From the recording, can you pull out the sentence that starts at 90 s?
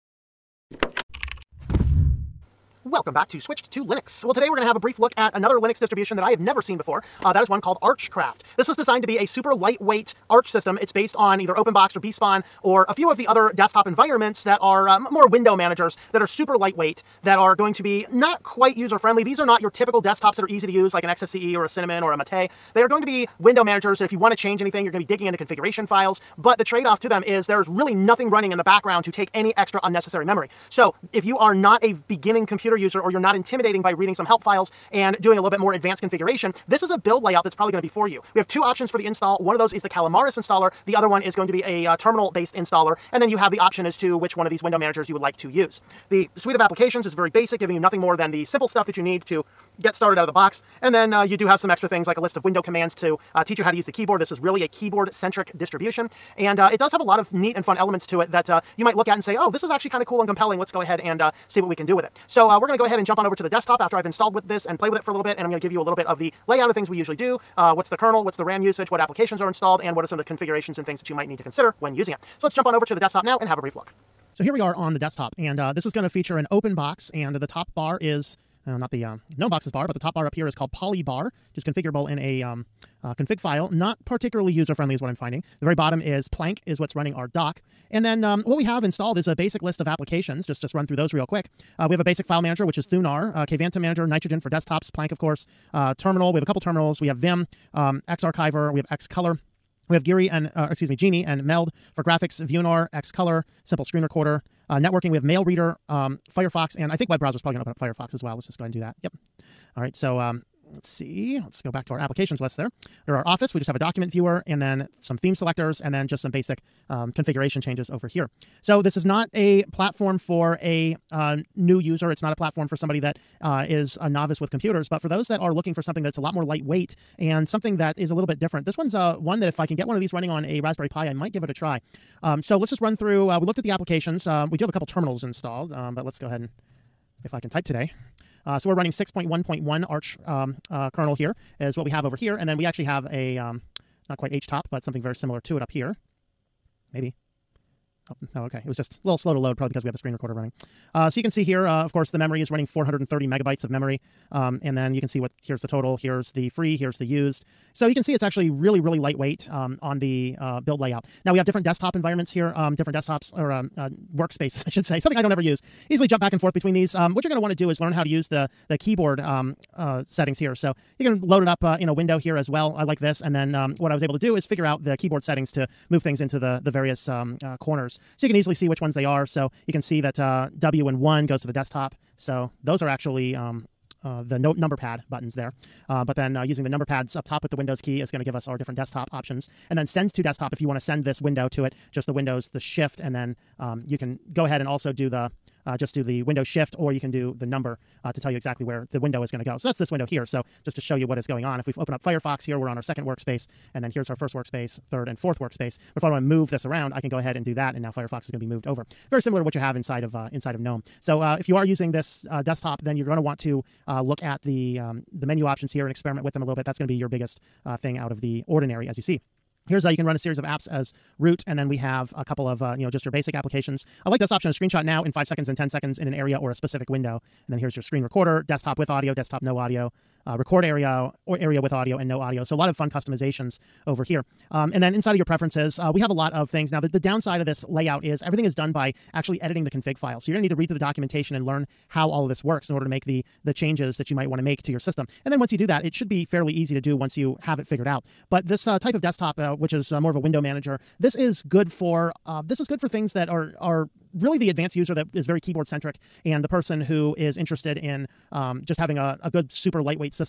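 Just, just run through those real quick.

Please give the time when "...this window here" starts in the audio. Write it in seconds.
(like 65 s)
199 s.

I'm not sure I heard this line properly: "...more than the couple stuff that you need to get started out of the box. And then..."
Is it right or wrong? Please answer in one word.
wrong.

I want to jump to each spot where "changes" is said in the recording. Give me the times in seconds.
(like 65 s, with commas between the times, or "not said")
24 s, 117 s, 243 s.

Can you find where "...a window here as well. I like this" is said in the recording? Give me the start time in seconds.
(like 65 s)
171 s.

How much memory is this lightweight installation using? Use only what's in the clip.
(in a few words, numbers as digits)
430 megabytes.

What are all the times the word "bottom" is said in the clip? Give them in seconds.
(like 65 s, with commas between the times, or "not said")
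85 s.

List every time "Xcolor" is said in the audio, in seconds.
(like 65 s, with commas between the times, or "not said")
98 s, 102 s.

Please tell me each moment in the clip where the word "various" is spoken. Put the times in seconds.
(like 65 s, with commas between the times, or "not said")
176 s.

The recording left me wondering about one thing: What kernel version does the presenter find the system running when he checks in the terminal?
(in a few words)
6.1.1.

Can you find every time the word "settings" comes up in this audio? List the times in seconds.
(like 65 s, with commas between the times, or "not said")
170 s, 175 s.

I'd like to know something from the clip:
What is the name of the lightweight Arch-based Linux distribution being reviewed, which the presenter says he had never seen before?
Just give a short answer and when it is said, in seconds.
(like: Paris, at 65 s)
Archcraft, at 7 s.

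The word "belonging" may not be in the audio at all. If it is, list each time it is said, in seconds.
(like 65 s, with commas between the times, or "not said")
not said.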